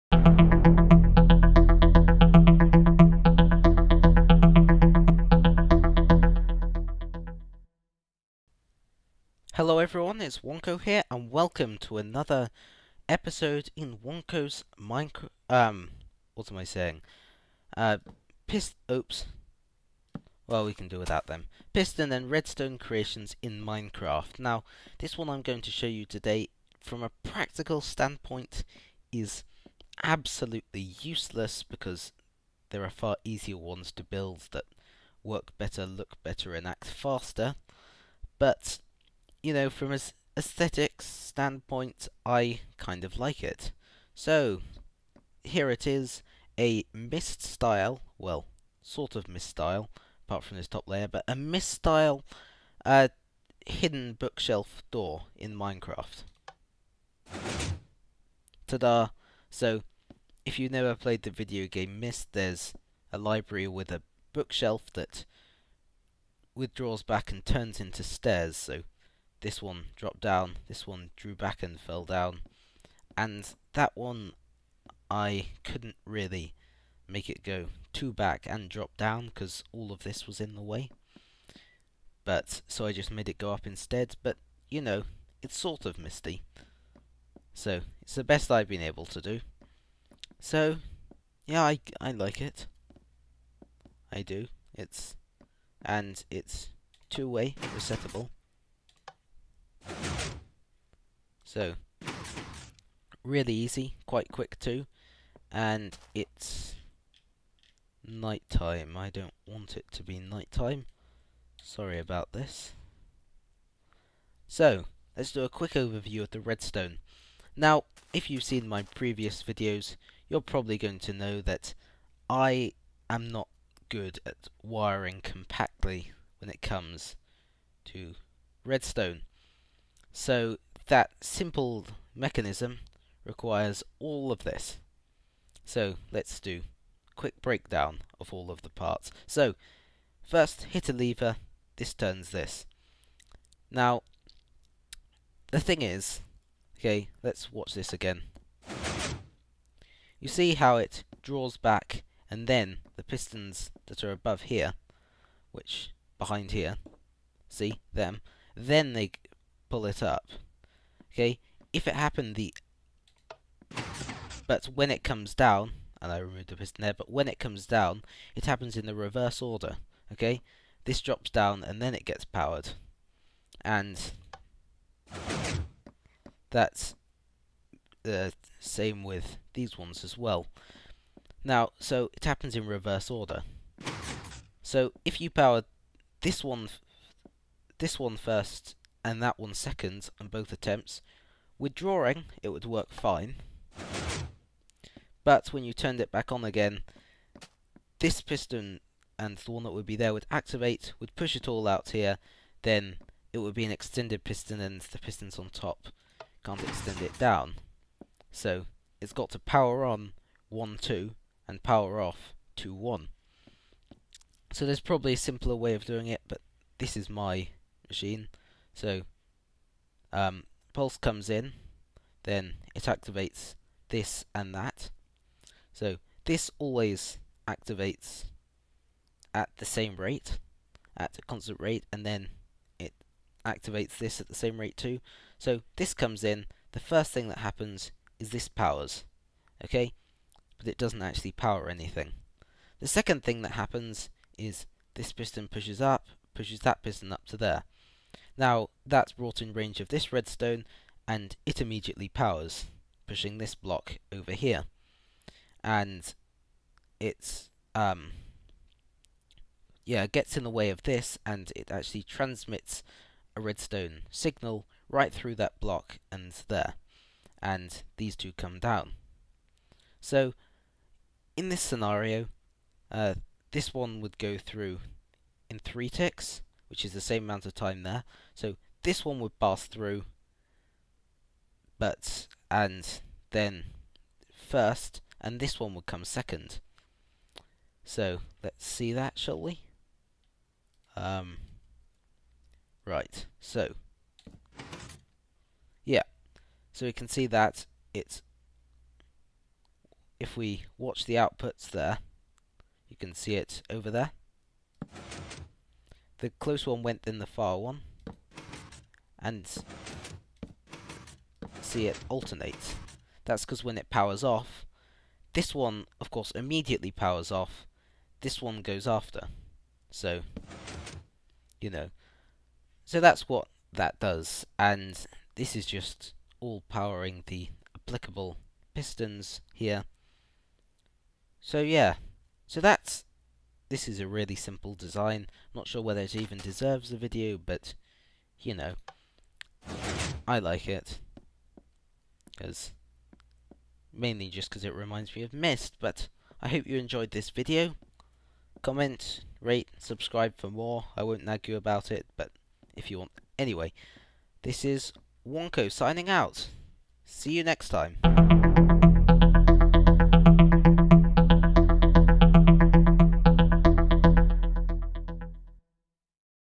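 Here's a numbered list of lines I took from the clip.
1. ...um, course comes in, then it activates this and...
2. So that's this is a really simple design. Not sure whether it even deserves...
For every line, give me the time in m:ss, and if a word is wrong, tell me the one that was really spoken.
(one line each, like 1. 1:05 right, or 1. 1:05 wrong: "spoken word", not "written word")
1. 3:40 wrong: "pulse", not "course"
2. 5:32 right.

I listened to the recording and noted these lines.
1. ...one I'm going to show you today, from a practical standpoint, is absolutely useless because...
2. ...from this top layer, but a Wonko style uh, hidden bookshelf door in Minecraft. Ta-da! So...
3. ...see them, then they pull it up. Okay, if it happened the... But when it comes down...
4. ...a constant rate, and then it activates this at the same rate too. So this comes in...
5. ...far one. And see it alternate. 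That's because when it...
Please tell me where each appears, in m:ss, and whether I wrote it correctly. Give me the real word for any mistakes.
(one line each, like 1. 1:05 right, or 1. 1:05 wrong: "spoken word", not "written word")
1. 0:25 right
2. 0:50 wrong: "Myst", not "Wonko"
3. 2:37 right
4. 3:51 right
5. 5:07 right.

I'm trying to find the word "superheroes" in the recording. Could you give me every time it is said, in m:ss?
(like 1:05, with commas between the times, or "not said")
not said.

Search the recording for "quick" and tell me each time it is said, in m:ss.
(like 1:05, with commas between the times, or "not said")
1:44, 1:55, 2:17.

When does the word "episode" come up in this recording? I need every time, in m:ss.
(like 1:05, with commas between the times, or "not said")
0:13.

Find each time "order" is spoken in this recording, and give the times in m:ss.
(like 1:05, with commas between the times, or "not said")
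2:49, 3:03.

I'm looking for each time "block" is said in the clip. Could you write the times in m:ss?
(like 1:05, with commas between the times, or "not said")
4:13, 4:25.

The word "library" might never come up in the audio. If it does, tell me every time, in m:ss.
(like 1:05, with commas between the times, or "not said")
1:03.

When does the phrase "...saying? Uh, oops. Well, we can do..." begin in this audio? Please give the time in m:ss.
0:16.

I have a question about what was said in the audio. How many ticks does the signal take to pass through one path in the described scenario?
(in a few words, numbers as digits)
3.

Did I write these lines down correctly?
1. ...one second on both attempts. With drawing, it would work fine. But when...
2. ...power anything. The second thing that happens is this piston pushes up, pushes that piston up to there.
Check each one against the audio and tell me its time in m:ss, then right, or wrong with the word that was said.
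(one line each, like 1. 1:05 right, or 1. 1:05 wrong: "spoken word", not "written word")
1. 3:09 right
2. 4:01 right.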